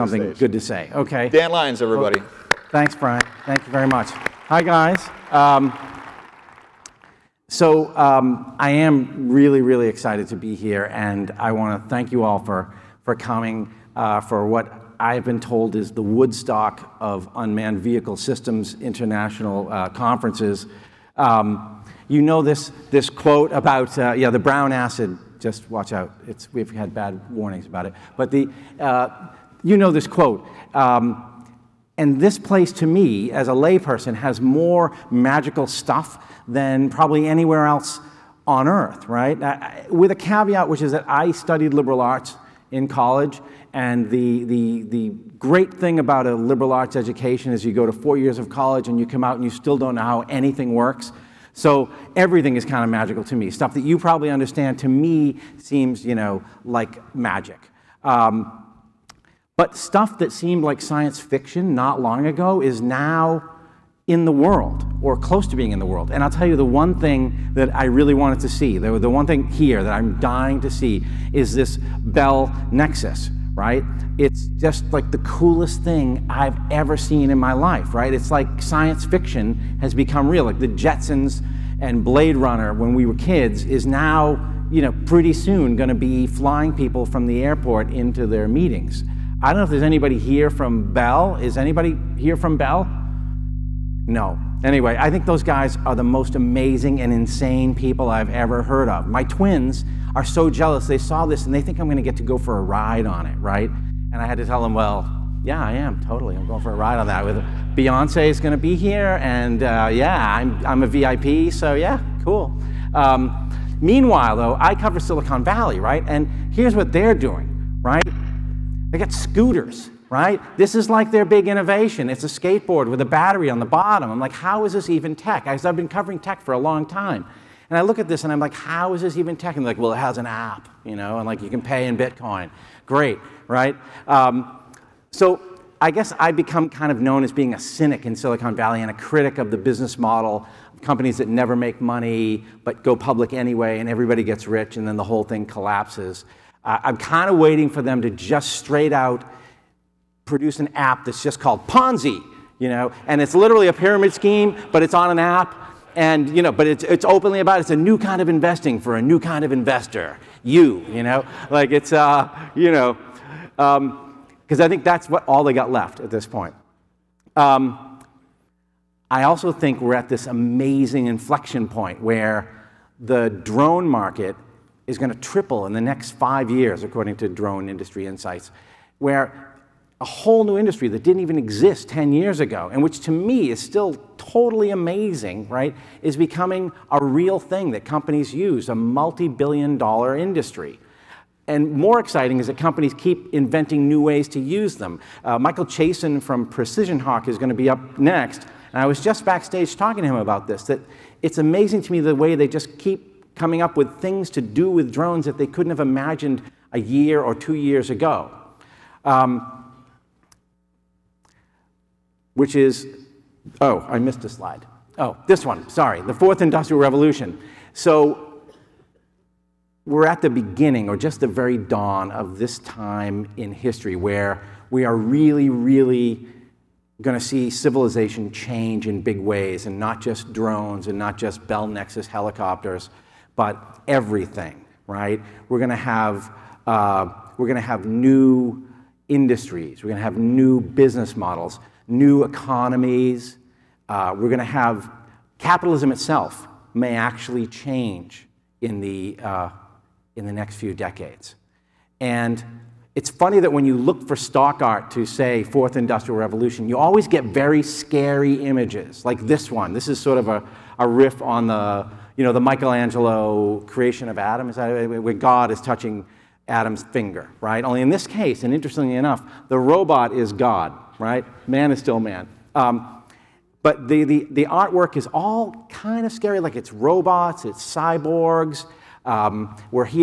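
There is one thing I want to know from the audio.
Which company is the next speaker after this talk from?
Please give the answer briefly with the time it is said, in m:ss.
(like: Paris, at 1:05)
PrecisionHawk, at 3:16.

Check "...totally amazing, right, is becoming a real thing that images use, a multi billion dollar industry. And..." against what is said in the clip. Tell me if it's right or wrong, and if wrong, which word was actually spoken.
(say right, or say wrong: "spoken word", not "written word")
wrong: "companies", not "images".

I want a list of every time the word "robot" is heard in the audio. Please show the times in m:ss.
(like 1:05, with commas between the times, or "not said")
4:29, 4:36.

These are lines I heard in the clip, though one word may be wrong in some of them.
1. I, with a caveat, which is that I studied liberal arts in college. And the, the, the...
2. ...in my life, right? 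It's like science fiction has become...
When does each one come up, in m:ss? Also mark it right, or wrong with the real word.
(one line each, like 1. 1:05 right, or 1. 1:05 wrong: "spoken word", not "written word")
1. 0:39 right
2. 1:17 right.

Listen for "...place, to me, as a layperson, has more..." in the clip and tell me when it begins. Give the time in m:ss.
0:32.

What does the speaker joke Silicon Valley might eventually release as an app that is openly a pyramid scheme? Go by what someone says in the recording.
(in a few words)
Ponzi.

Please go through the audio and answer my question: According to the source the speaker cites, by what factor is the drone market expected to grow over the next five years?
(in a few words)
triple.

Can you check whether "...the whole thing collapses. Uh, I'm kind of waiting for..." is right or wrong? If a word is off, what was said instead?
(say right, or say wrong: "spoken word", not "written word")
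right.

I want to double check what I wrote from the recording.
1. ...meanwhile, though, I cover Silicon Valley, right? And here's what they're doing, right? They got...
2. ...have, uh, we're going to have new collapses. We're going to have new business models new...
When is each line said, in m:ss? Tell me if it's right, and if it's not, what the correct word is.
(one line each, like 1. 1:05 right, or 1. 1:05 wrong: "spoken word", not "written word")
1. 1:53 right
2. 3:55 wrong: "industries", not "collapses".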